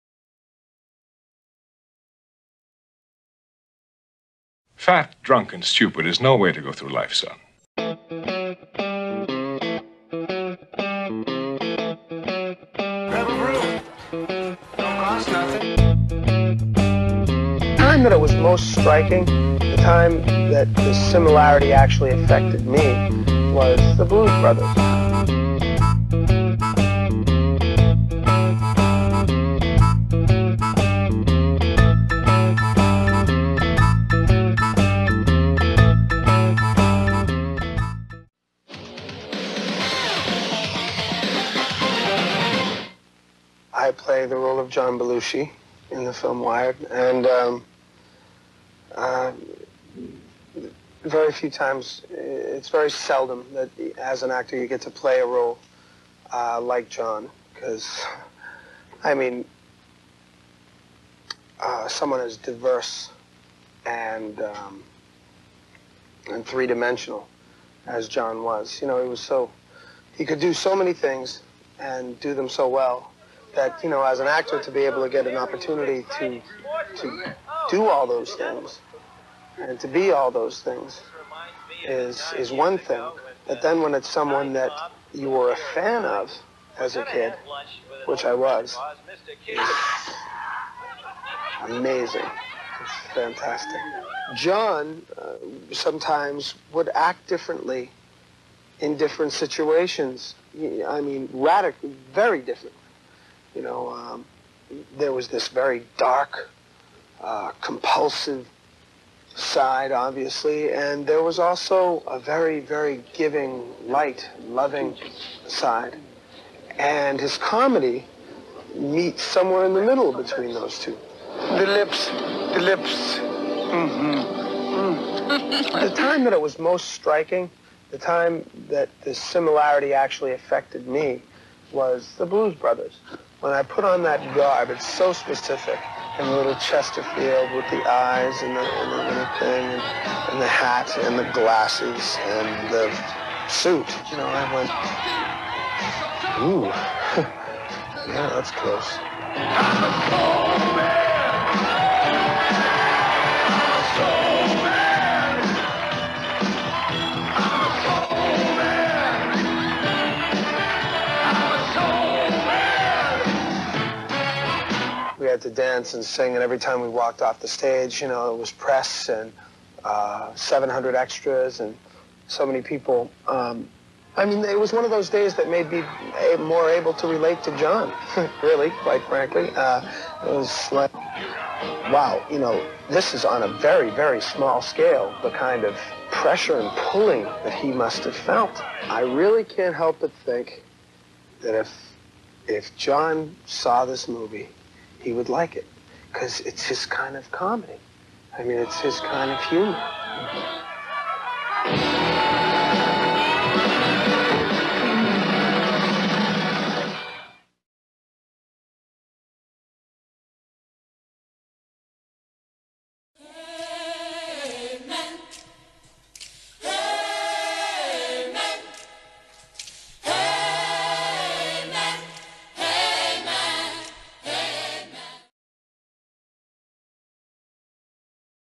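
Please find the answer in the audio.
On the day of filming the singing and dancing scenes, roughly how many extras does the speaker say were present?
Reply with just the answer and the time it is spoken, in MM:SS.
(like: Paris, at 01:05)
700, at 02:50.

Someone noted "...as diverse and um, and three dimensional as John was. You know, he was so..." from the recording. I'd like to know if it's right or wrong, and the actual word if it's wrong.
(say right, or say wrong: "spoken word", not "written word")
right.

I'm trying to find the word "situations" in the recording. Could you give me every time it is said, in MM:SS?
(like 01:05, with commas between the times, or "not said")
01:39.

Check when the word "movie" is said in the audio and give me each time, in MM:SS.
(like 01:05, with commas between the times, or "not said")
03:14.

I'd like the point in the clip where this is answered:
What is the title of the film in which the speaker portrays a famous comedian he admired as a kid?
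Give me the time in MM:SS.
00:46.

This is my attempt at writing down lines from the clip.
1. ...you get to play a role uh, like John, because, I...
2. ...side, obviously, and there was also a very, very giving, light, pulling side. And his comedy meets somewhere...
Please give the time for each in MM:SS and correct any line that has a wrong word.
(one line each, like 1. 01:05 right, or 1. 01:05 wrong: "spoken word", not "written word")
1. 00:54 right
2. 01:49 wrong: "loving", not "pulling".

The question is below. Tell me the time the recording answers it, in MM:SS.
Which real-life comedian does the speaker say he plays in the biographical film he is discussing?
00:44.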